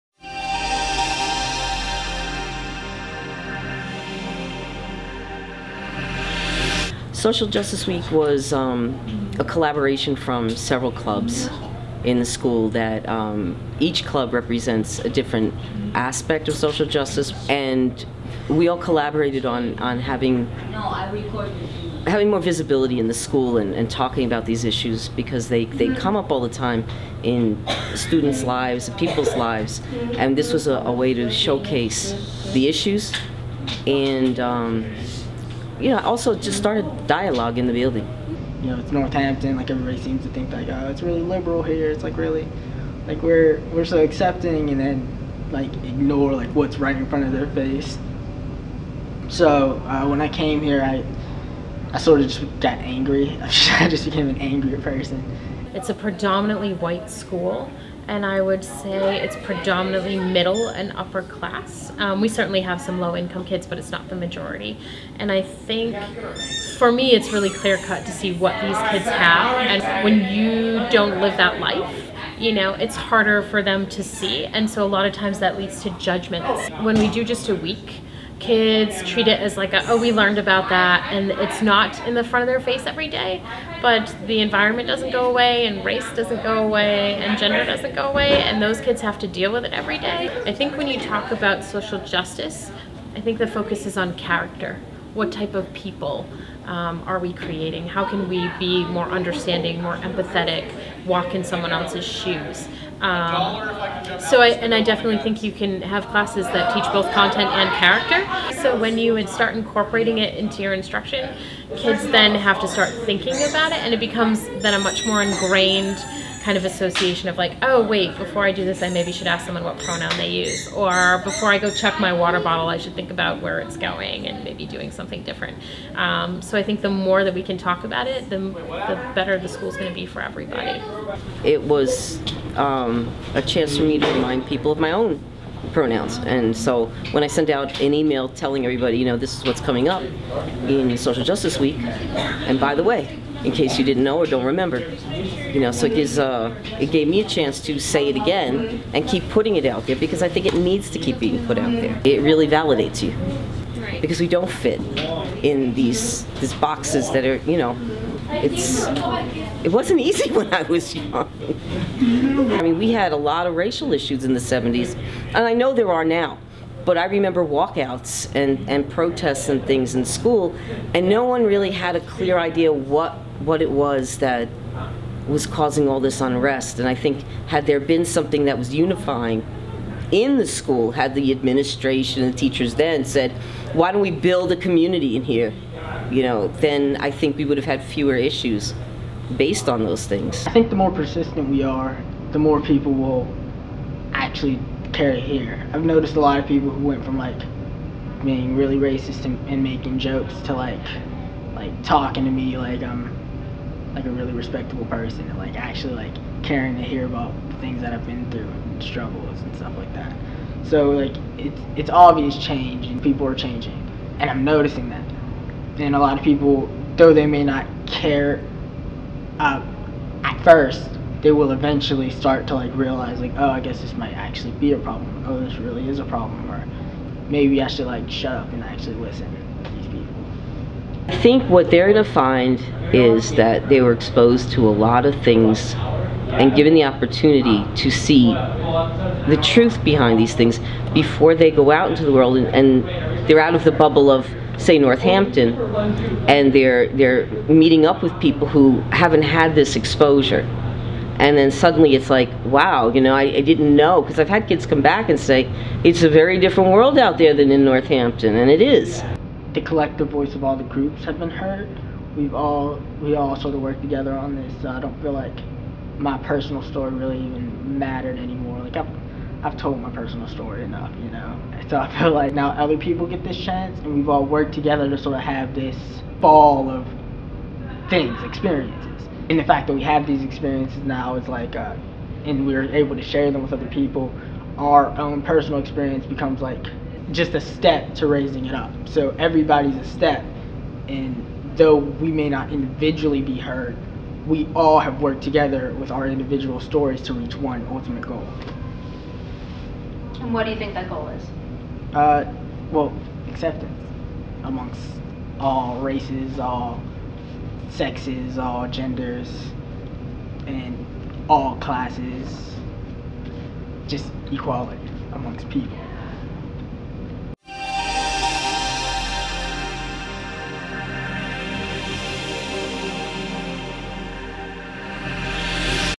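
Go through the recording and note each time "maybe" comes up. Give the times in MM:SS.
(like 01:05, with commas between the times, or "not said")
01:58, 02:04, 03:47.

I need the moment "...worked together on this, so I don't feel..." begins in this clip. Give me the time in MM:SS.
04:23.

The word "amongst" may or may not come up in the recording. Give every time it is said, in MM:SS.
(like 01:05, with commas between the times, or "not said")
05:04, 05:15.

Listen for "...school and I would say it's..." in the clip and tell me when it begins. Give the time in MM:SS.
00:57.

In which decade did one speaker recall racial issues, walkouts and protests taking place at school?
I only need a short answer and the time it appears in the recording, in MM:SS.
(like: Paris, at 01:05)
1970s, at 02:44.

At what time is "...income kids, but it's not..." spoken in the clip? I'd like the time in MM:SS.
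01:03.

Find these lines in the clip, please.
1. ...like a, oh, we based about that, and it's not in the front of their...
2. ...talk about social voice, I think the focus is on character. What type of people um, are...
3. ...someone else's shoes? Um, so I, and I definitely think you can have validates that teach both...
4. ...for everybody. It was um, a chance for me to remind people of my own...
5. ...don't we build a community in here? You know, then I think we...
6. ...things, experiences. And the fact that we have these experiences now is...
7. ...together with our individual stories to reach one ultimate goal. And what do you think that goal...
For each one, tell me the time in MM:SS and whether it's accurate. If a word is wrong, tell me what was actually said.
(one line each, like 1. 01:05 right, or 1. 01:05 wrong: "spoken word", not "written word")
1. 01:19 wrong: "learned", not "based"
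2. 01:30 wrong: "justice", not "voice"
3. 01:41 wrong: "classes", not "validates"
4. 02:10 right
5. 03:03 right
6. 04:37 right
7. 04:55 right.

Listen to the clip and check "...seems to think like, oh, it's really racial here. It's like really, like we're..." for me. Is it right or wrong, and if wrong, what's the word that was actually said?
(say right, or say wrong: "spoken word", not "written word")
wrong: "liberal", not "racial".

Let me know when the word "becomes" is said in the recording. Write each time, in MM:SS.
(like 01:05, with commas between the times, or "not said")
01:53, 04:46.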